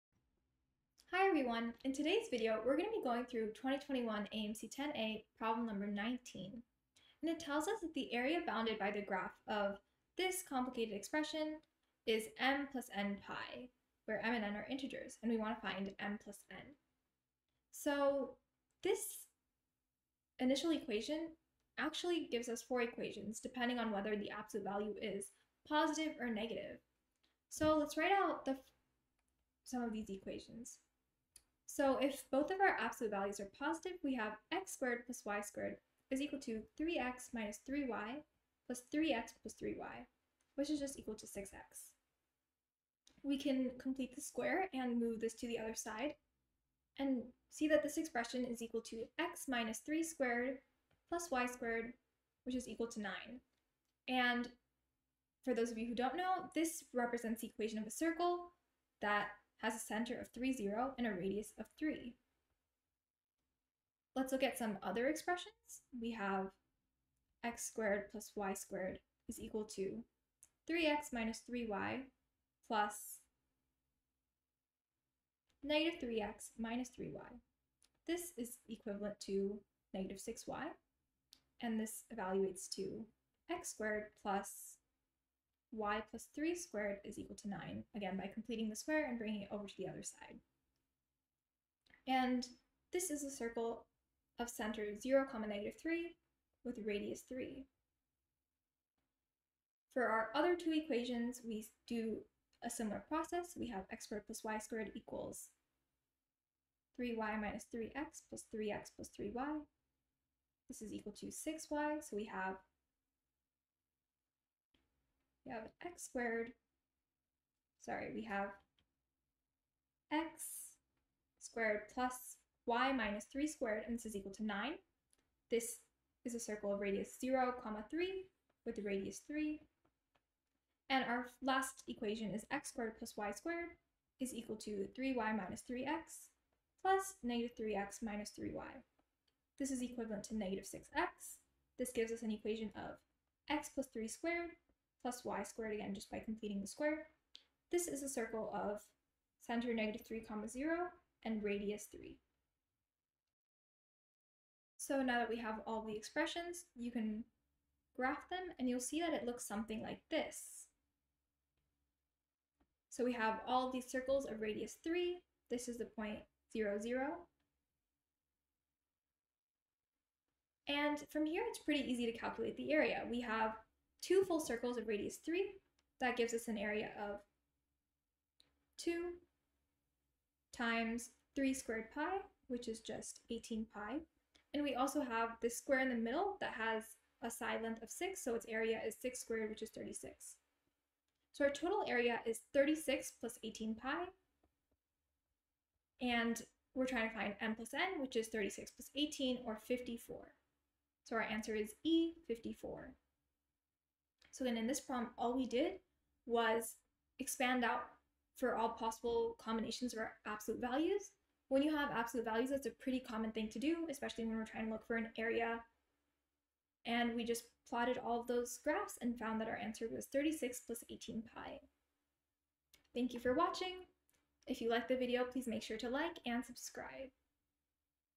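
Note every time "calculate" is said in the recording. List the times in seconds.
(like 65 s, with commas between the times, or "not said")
172 s.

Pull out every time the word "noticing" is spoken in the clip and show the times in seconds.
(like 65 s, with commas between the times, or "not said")
not said.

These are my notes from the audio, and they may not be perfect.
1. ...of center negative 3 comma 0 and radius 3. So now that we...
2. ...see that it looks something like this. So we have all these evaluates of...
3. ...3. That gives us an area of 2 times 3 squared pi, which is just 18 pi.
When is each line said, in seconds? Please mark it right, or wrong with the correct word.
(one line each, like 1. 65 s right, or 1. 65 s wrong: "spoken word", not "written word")
1. 148 s right
2. 158 s wrong: "circles", not "evaluates"
3. 175 s right.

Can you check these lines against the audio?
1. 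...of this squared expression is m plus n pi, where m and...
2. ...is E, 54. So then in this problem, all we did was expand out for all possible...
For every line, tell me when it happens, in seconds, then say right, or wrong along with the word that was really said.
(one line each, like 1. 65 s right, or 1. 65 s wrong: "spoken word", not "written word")
1. 9 s wrong: "complicated", not "squared"
2. 201 s right.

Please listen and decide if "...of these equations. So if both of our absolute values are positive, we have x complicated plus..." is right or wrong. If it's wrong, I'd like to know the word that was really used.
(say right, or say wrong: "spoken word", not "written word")
wrong: "squared", not "complicated".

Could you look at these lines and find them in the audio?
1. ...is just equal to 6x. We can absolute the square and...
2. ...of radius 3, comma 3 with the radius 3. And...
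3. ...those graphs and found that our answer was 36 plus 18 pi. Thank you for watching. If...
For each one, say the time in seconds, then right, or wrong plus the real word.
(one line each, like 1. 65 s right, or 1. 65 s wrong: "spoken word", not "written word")
1. 40 s wrong: "complete", not "absolute"
2. 126 s wrong: "0", not "3"
3. 218 s right.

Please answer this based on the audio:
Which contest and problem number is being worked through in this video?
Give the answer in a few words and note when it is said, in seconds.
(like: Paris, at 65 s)
2021 AMC 10A problem 19, at 3 s.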